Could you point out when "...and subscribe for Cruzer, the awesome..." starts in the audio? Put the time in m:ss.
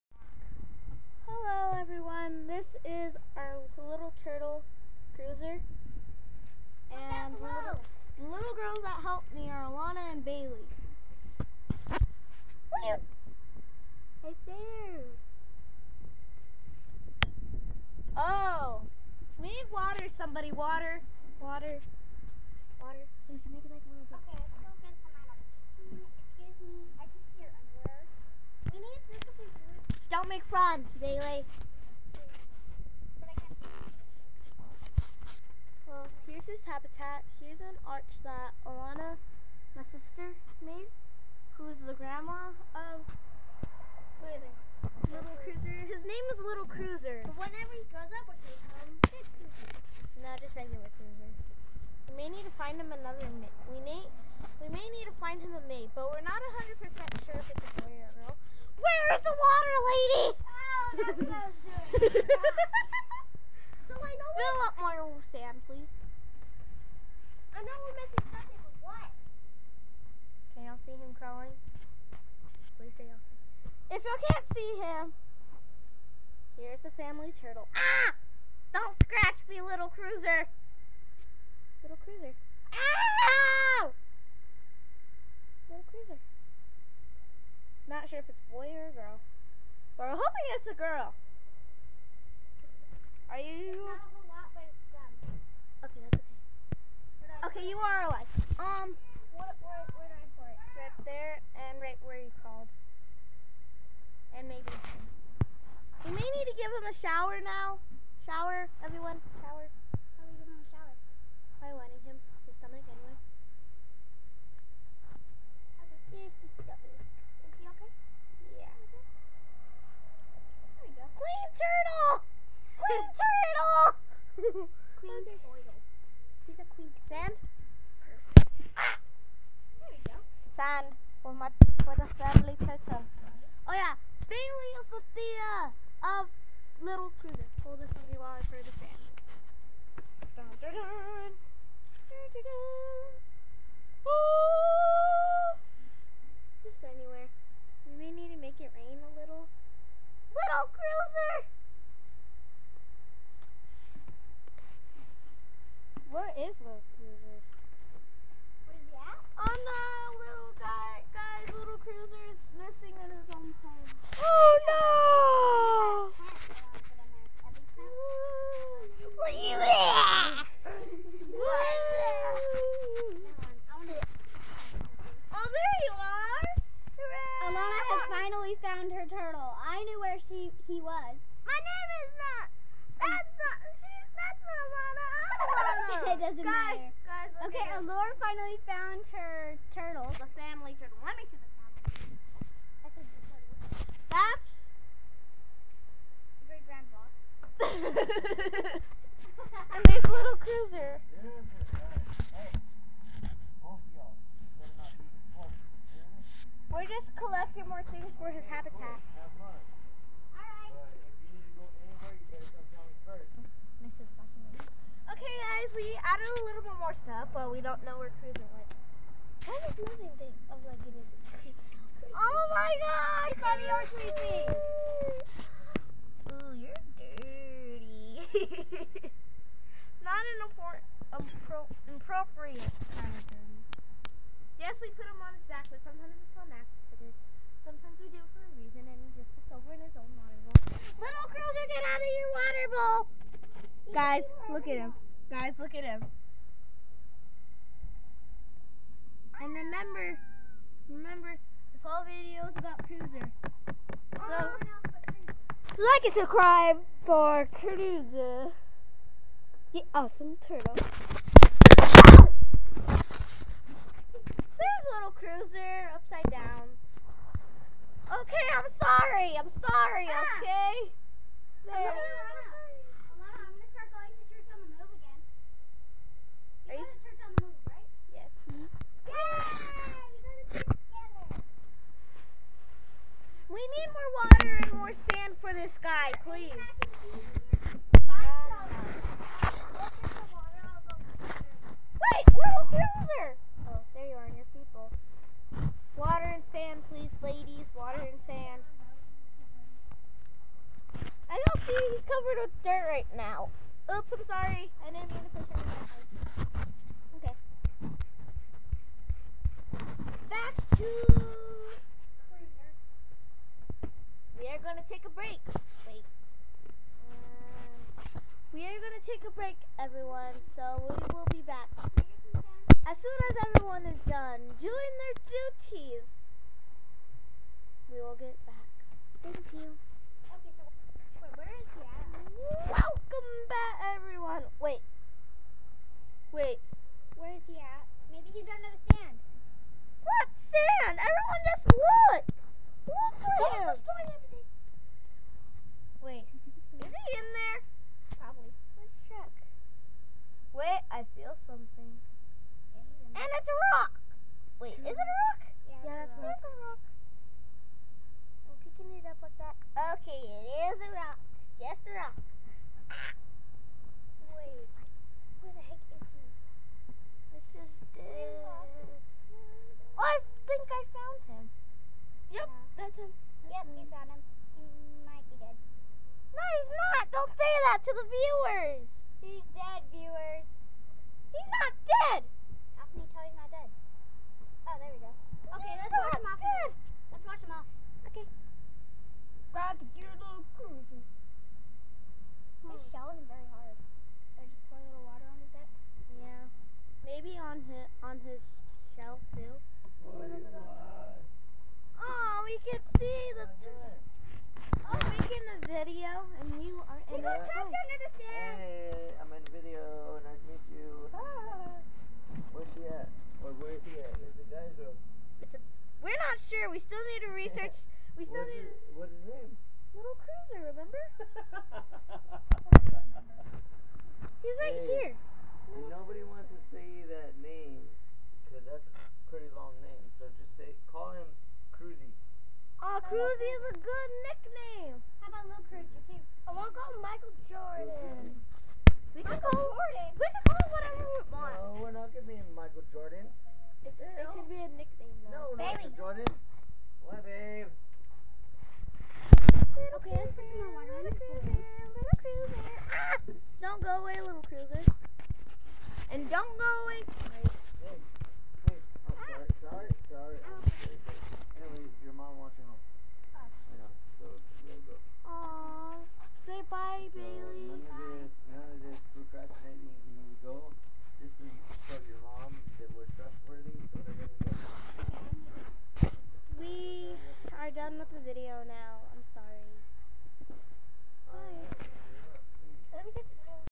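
4:16.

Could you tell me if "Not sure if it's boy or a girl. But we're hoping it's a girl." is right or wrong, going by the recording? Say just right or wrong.
right.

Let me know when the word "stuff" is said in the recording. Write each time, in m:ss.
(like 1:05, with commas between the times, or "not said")
3:37.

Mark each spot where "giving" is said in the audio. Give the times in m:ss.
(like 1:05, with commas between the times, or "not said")
1:50.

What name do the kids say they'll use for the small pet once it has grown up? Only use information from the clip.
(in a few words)
Big Cruzer.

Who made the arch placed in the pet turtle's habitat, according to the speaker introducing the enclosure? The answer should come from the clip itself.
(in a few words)
Alana.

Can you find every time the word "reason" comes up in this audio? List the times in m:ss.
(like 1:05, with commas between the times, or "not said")
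3:58.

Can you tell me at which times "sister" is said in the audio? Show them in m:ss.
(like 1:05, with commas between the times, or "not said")
0:39.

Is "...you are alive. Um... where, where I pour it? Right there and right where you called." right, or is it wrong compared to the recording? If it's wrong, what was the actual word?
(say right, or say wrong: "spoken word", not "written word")
right.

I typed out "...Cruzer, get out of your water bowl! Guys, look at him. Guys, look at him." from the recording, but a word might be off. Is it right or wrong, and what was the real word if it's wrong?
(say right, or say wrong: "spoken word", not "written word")
right.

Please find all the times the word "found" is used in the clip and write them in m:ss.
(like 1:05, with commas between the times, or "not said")
3:08, 6:13.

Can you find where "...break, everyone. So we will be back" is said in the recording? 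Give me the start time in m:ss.
5:19.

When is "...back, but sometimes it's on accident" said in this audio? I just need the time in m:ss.
3:55.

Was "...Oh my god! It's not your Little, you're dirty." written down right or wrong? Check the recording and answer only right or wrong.
wrong.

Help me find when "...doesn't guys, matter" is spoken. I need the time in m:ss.
3:06.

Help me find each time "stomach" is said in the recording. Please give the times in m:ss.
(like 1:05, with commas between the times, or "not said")
1:52, 1:56.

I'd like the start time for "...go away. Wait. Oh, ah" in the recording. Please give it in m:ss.
7:36.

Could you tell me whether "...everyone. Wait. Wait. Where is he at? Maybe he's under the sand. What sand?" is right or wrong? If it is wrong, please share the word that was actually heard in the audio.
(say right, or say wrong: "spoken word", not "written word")
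right.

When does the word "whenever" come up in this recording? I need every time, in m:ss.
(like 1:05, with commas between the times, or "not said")
0:47.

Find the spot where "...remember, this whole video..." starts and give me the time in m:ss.
4:10.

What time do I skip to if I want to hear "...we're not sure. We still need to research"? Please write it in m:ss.
6:56.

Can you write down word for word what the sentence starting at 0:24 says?
Okay, let's go get some Excuse me, I can see your underwear.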